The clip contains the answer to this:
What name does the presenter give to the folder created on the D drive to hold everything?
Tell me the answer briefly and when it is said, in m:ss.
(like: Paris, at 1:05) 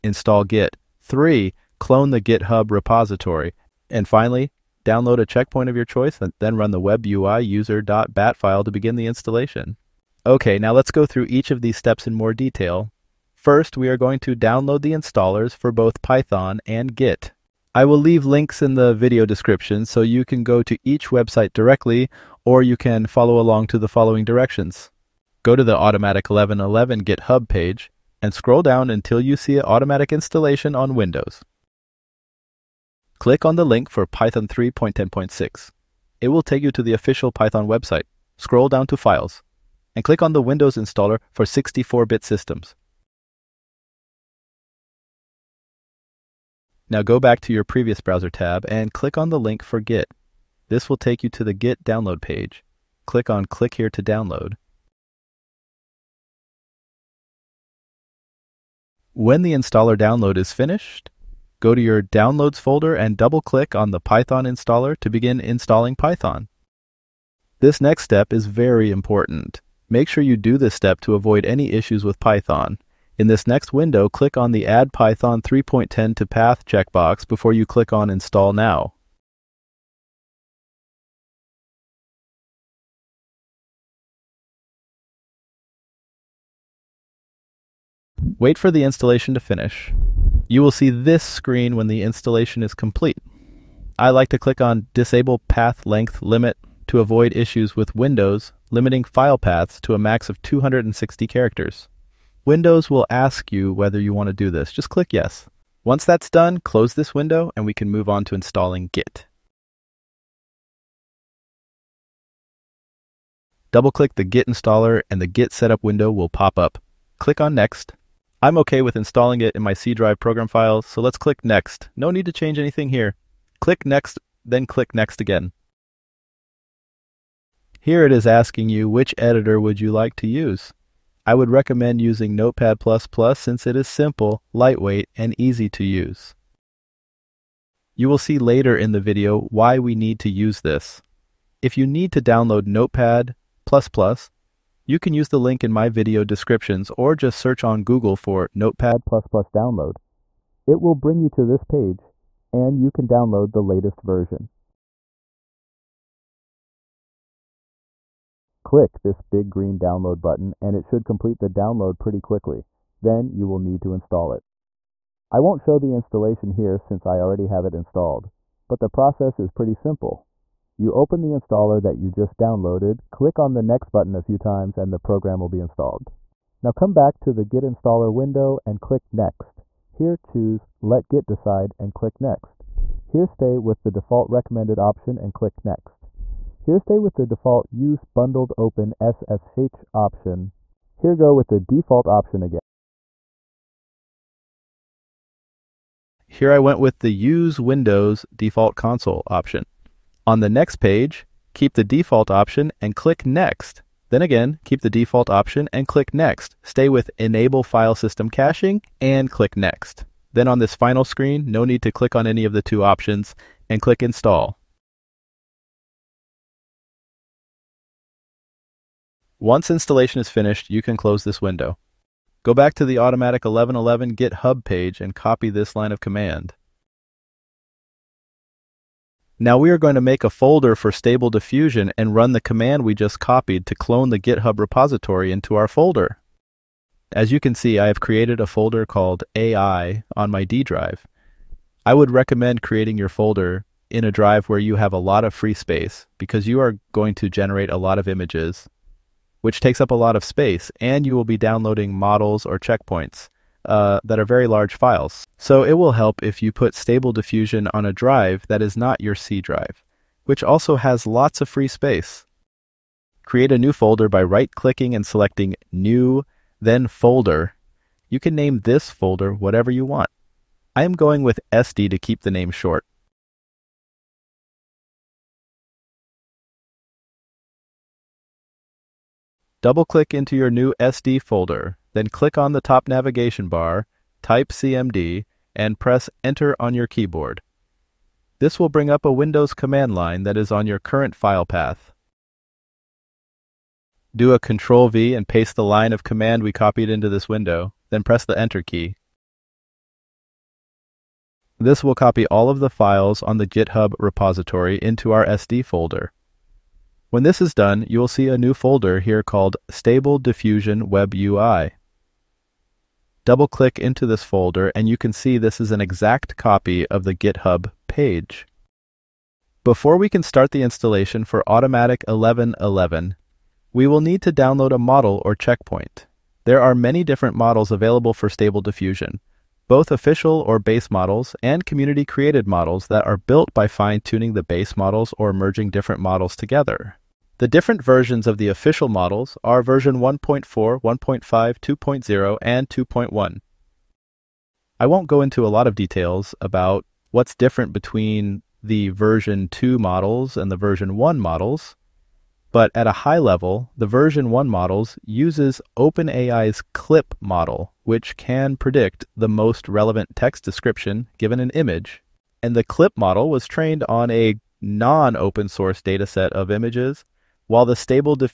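AI, at 3:59.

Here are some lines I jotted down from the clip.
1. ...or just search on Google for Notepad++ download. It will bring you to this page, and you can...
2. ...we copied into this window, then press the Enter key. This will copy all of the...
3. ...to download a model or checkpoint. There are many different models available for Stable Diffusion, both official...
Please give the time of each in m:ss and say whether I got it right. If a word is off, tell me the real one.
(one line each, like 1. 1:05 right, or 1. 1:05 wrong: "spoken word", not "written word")
1. 2:26 right
2. 4:56 right
3. 5:24 right.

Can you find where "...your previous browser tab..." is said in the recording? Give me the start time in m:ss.
0:47.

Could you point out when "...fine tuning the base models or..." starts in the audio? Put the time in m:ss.
5:33.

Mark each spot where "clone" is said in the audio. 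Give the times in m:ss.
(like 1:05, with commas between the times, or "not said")
0:01, 3:53.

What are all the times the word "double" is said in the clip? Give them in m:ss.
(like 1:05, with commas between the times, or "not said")
1:03, 1:53, 4:39, 5:13.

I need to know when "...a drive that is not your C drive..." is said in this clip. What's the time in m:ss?
4:17.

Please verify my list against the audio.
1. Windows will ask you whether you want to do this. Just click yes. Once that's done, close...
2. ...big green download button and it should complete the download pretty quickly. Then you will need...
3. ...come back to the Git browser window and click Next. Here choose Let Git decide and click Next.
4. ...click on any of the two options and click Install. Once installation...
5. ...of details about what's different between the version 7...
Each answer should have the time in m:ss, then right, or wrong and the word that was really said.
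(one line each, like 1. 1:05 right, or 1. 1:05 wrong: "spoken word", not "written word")
1. 1:42 right
2. 2:39 right
3. 2:56 wrong: "installer", not "browser"
4. 3:31 right
5. 5:45 wrong: "2", not "7".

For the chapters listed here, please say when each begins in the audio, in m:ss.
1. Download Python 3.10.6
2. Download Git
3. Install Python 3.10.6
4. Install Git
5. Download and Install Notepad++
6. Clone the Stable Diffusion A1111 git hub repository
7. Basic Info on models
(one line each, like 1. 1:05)
1. 0:37
2. 0:51
3. 1:02
4. 1:52
5. 2:31
6. 3:46
7. 5:18.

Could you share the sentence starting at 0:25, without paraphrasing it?
Go to the Automatic 1111 GitHub page and scroll down until you see Automatic Installation on Windows.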